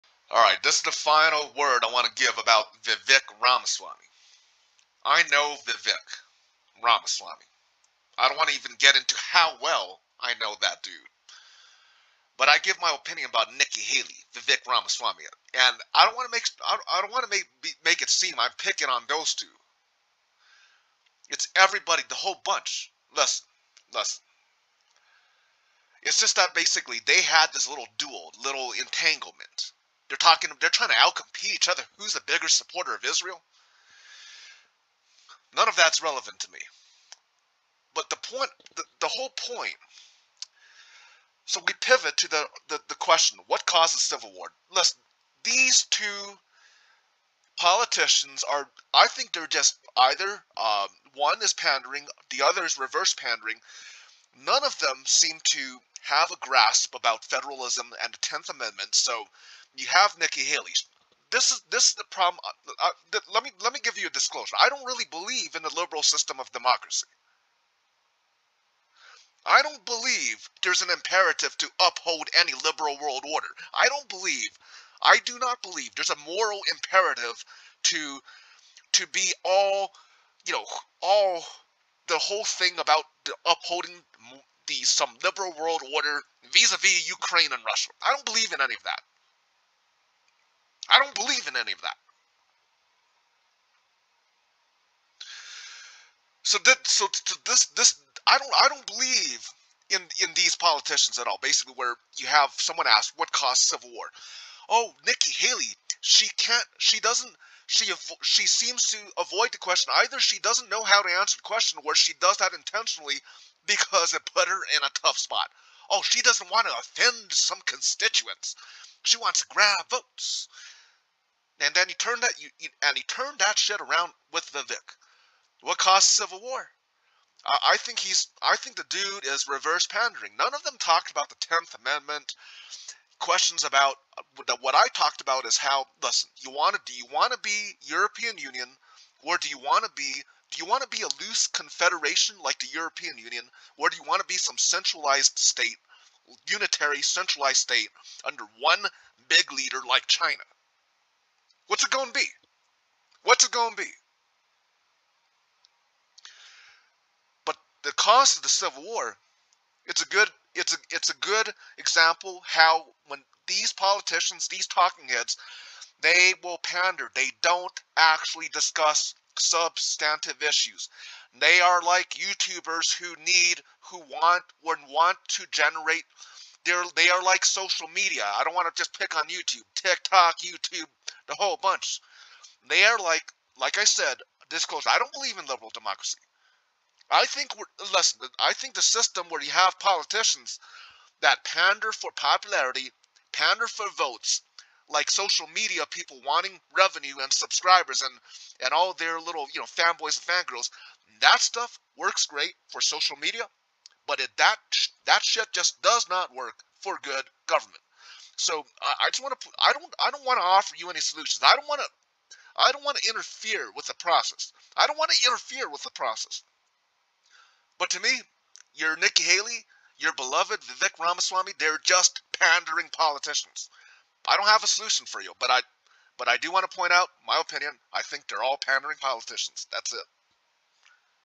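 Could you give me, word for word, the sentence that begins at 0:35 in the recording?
None of that's relevant to me.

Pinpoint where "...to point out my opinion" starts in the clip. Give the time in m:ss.
3:46.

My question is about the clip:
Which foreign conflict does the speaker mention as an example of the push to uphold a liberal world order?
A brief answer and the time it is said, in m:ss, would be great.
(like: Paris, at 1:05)
Ukraine and Russia, at 1:27.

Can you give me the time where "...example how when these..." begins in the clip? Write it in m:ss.
2:41.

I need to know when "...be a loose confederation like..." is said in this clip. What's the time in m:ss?
2:20.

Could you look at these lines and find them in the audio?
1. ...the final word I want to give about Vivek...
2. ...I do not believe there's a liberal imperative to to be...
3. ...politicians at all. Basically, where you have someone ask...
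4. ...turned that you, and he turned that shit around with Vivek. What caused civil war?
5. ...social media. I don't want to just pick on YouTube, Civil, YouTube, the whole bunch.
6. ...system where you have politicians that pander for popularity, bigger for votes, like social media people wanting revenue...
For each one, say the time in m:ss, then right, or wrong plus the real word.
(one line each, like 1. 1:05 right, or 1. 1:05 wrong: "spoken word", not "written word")
1. 0:00 right
2. 1:15 wrong: "moral", not "liberal"
3. 1:40 right
4. 2:01 right
5. 2:57 wrong: "TikTok", not "Civil"
6. 3:08 wrong: "pander", not "bigger".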